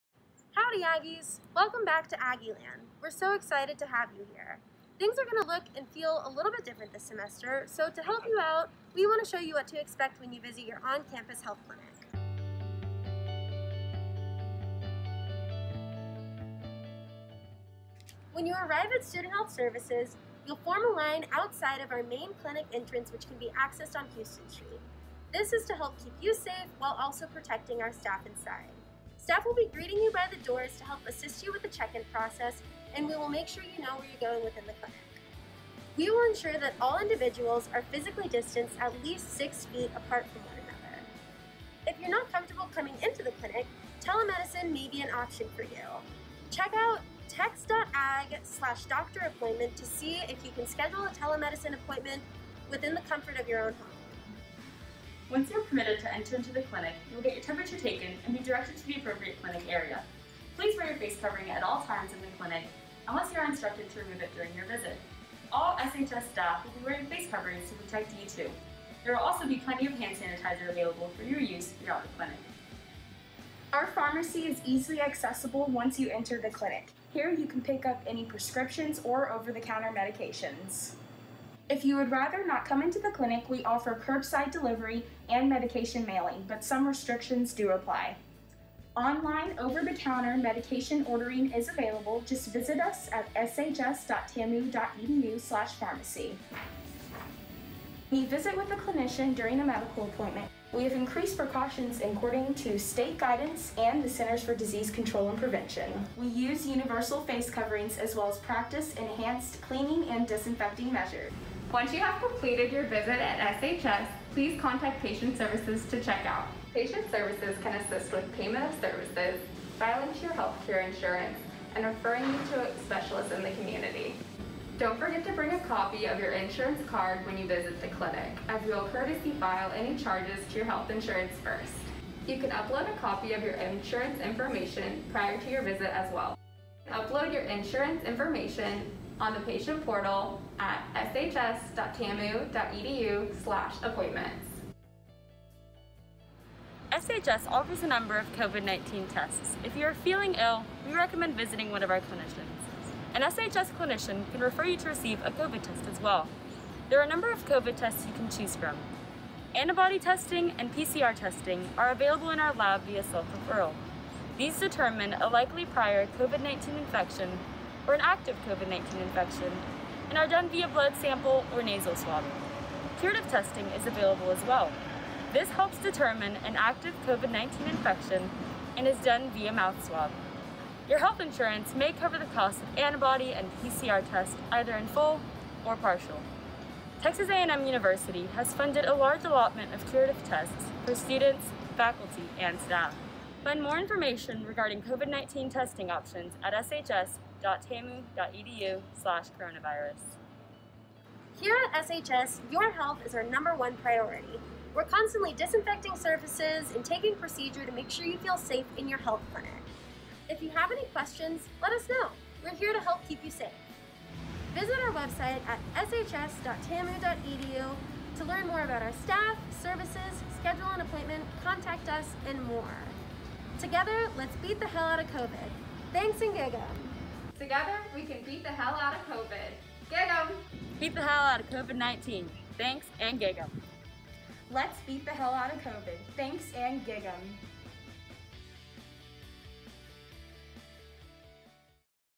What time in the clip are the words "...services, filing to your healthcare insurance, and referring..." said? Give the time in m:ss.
1:58.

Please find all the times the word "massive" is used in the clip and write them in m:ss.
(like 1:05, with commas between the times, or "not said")
not said.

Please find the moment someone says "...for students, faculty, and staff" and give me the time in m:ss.
3:10.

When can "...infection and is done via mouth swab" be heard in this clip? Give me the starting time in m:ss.
2:57.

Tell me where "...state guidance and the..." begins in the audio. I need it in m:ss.
1:42.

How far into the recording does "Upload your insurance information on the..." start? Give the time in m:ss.
2:16.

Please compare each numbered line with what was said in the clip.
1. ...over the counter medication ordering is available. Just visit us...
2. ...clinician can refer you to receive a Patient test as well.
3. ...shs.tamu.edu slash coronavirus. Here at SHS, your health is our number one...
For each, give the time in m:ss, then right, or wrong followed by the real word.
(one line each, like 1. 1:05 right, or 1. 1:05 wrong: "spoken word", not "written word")
1. 1:29 right
2. 2:33 wrong: "COVID", not "Patient"
3. 3:16 right.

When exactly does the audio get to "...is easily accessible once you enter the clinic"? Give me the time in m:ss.
1:14.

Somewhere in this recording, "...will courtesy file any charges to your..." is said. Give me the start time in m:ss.
2:08.